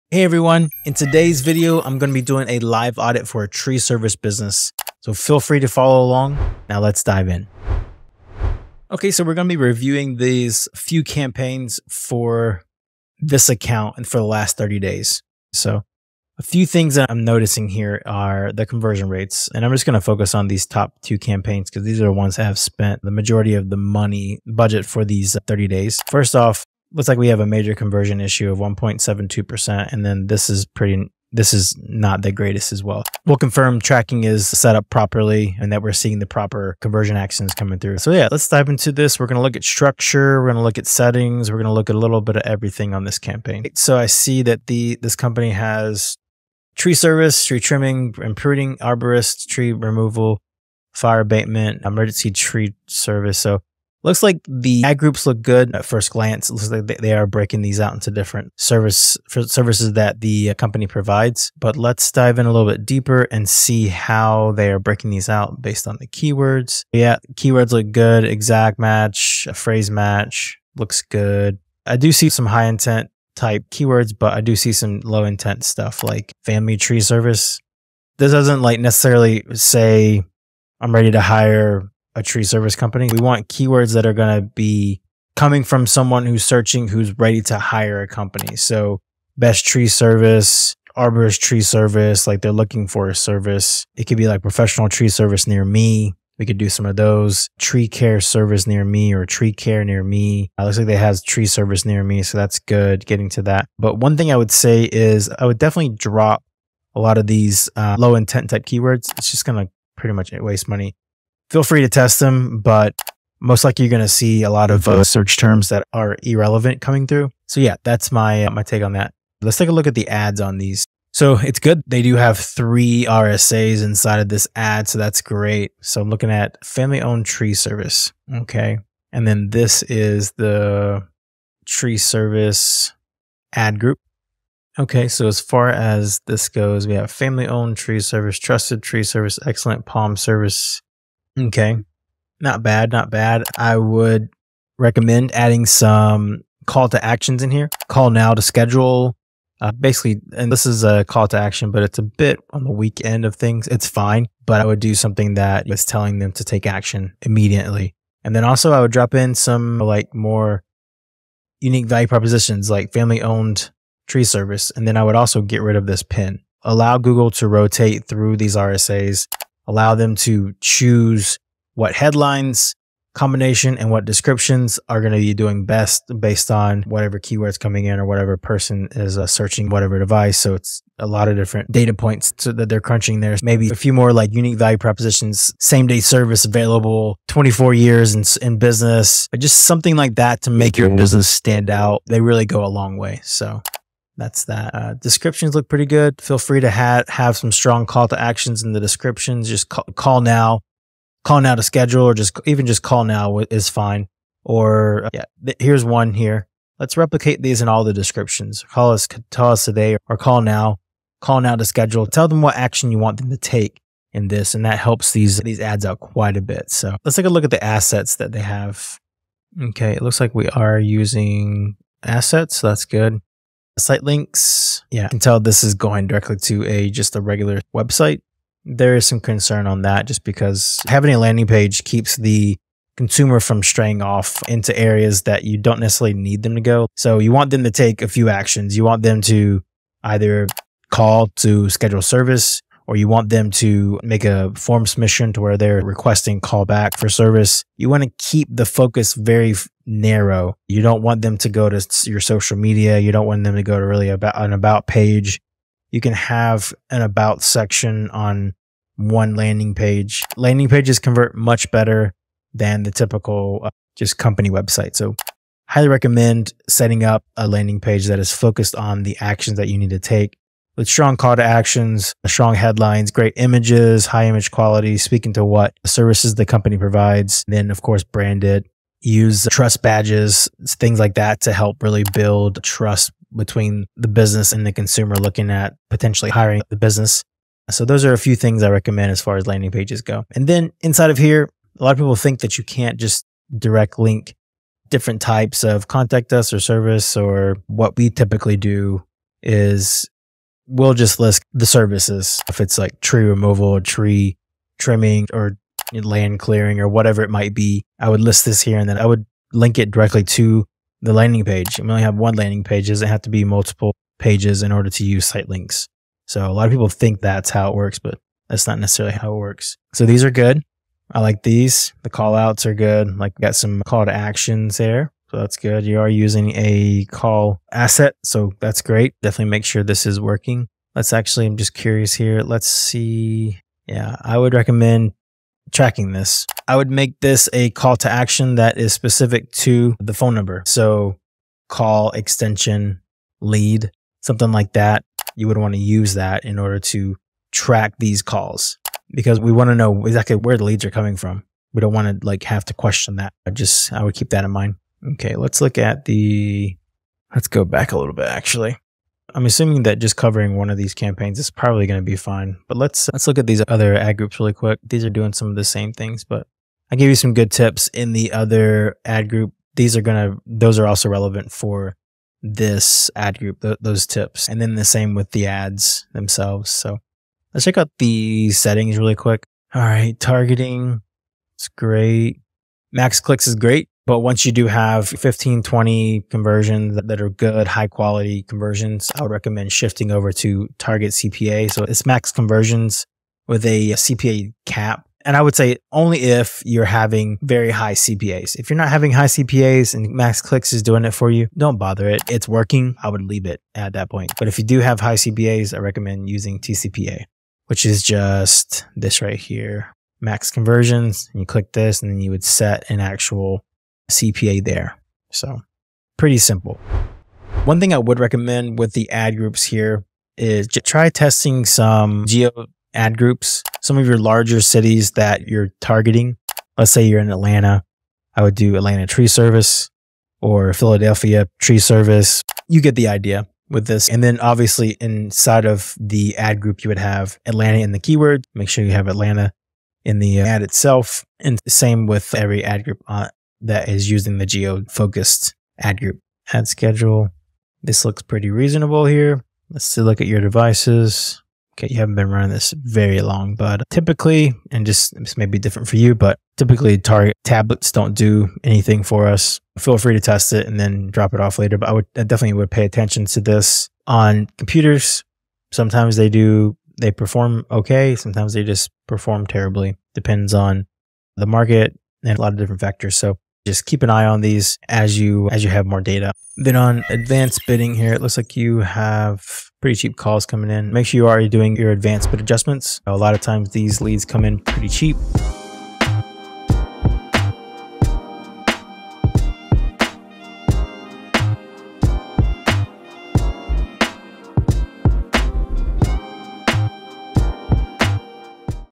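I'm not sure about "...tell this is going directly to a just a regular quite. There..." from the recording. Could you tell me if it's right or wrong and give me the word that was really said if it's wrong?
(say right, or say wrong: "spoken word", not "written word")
wrong: "website", not "quite".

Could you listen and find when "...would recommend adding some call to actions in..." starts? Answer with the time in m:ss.
2:23.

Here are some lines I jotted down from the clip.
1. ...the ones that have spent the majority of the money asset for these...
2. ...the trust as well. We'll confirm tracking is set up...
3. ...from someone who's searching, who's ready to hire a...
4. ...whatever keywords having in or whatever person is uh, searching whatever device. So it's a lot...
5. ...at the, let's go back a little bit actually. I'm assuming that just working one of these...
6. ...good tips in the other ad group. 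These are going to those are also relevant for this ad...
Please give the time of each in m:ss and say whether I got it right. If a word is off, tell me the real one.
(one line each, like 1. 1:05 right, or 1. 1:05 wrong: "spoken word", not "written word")
1. 0:22 wrong: "budget", not "asset"
2. 0:32 wrong: "greatest", not "trust"
3. 1:25 right
4. 2:56 wrong: "coming", not "having"
5. 5:55 wrong: "covering", not "working"
6. 6:07 right.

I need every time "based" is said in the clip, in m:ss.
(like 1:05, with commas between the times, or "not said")
1:05, 2:56.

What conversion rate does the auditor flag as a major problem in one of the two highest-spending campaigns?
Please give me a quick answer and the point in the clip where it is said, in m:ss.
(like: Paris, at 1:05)
1.72%, at 0:28.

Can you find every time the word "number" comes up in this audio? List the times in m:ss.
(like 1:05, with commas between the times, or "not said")
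5:40.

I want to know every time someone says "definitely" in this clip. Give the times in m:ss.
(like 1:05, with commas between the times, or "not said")
1:45, 5:29, 7:42.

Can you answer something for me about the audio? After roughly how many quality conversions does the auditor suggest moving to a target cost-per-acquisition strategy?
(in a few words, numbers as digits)
15 to 20.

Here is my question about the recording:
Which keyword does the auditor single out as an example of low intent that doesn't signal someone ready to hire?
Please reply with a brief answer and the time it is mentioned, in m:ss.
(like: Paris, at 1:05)
family tree service, at 1:16.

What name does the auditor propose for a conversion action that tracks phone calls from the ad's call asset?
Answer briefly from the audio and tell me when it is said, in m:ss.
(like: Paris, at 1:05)
call extension lead, at 5:41.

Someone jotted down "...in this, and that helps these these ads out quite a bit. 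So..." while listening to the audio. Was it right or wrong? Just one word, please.
right.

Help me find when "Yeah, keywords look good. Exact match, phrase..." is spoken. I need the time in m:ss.
1:06.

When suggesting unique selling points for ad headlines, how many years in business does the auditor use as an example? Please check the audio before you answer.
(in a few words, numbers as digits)
24 years.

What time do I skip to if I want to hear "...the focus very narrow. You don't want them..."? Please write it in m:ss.
4:08.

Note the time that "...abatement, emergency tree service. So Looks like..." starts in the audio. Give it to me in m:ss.
0:51.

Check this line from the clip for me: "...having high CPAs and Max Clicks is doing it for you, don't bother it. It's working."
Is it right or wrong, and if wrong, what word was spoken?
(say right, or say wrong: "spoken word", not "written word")
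right.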